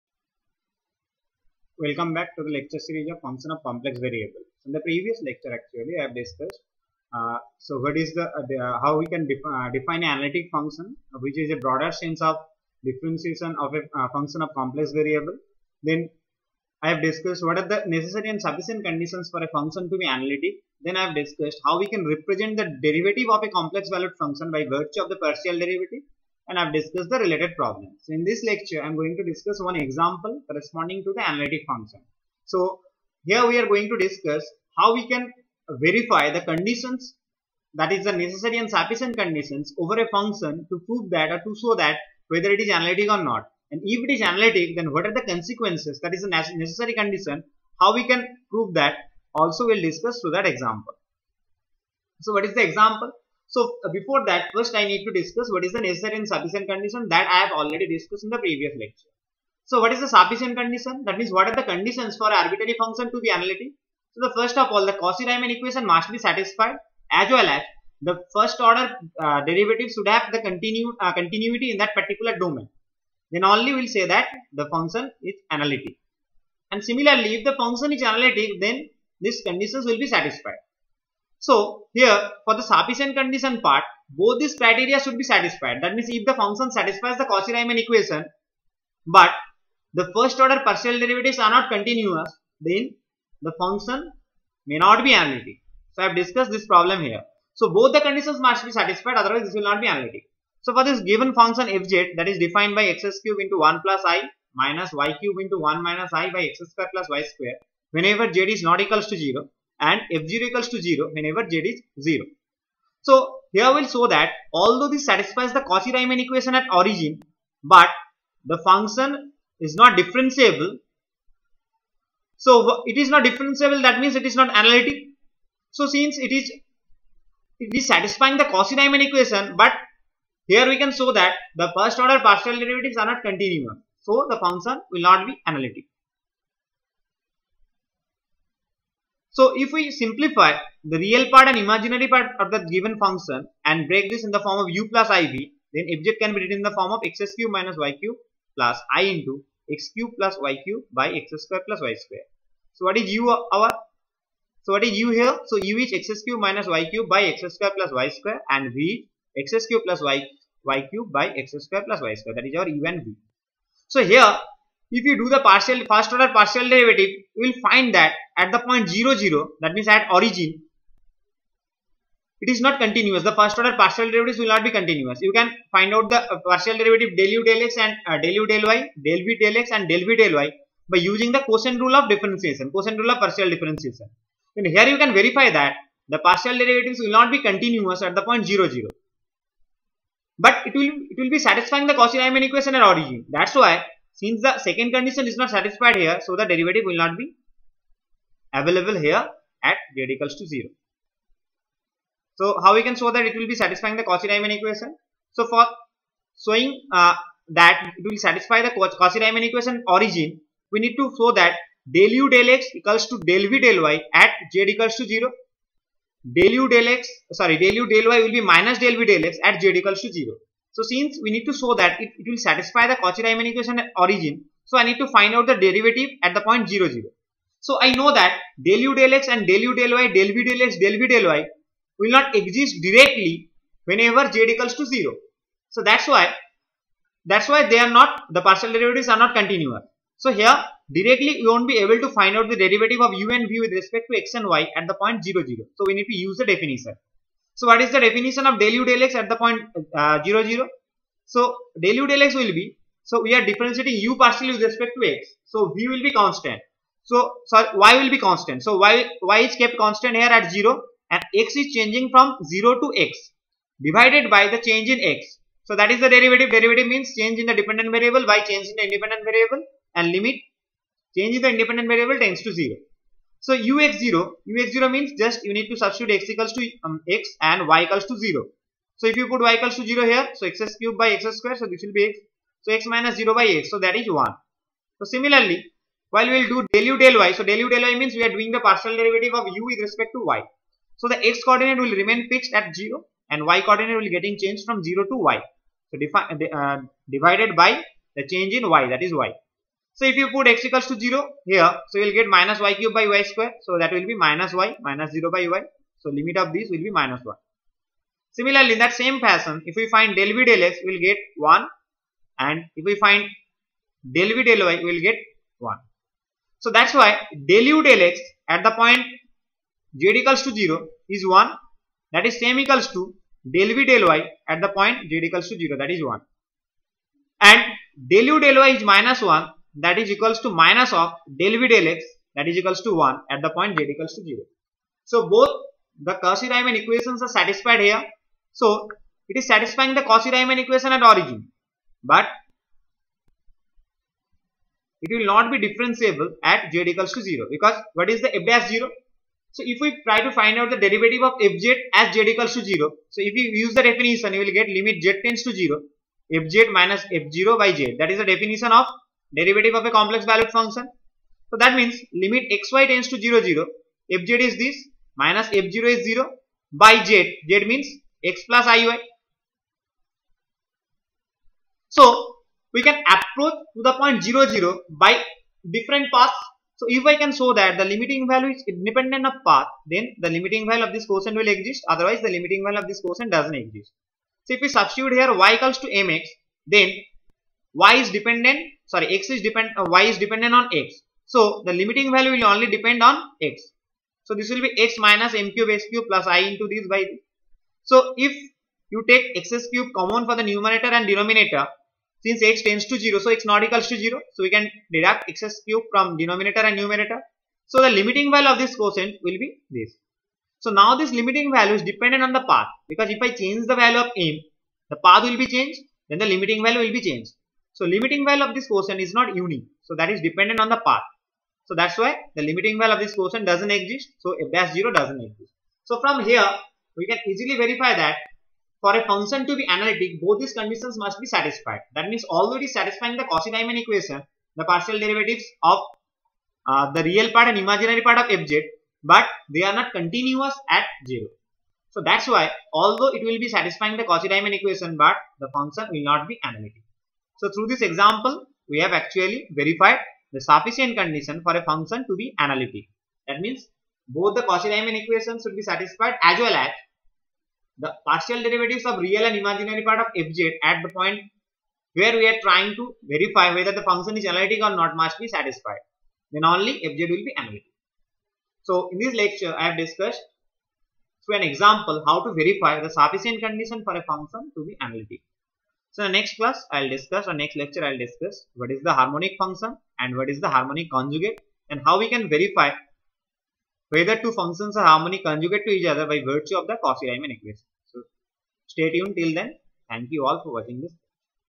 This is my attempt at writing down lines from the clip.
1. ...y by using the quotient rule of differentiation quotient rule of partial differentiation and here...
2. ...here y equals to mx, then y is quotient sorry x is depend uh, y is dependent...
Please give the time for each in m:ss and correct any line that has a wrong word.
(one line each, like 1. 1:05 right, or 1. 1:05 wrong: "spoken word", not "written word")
1. 3:00 right
2. 6:25 wrong: "dependent", not "quotient".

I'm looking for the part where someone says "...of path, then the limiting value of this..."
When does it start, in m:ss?
6:19.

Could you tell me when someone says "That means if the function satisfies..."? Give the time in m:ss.
1:25.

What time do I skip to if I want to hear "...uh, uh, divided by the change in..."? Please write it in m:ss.
4:56.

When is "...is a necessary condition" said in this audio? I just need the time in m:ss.
0:46.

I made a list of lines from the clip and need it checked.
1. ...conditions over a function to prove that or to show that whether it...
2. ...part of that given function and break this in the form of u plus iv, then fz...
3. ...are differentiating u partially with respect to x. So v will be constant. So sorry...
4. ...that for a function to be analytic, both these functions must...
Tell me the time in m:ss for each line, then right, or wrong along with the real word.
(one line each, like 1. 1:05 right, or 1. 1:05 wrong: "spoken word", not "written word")
1. 0:39 right
2. 2:22 right
3. 4:13 right
4. 7:07 wrong: "conditions", not "functions".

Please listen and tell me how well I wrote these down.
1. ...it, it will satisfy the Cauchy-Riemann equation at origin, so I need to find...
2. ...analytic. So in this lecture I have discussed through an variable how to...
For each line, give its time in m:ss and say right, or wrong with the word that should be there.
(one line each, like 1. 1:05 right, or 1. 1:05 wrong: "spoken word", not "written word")
1. 3:41 right
2. 7:47 wrong: "example", not "variable".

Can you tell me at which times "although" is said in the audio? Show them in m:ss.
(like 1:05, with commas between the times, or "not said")
1:54, 7:22.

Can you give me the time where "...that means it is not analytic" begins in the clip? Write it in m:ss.
2:03.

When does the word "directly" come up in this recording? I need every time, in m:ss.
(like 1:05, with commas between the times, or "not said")
3:52, 4:00.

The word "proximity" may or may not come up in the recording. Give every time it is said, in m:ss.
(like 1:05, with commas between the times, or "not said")
not said.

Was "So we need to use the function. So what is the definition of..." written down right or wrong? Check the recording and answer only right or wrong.
wrong.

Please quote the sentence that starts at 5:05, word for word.
So limit of this will be minus 1.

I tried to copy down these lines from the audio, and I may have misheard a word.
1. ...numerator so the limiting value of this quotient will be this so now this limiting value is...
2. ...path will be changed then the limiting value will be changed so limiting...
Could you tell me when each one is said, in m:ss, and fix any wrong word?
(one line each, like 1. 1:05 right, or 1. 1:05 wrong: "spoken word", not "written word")
1. 6:46 right
2. 6:55 right.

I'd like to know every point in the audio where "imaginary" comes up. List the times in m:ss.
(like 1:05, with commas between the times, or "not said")
2:21, 7:17, 7:39.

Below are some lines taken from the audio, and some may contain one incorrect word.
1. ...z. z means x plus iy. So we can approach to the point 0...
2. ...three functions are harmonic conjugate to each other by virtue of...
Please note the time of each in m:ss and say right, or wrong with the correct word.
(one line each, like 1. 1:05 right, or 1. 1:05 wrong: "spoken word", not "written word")
1. 6:07 right
2. 8:04 wrong: "two", not "three".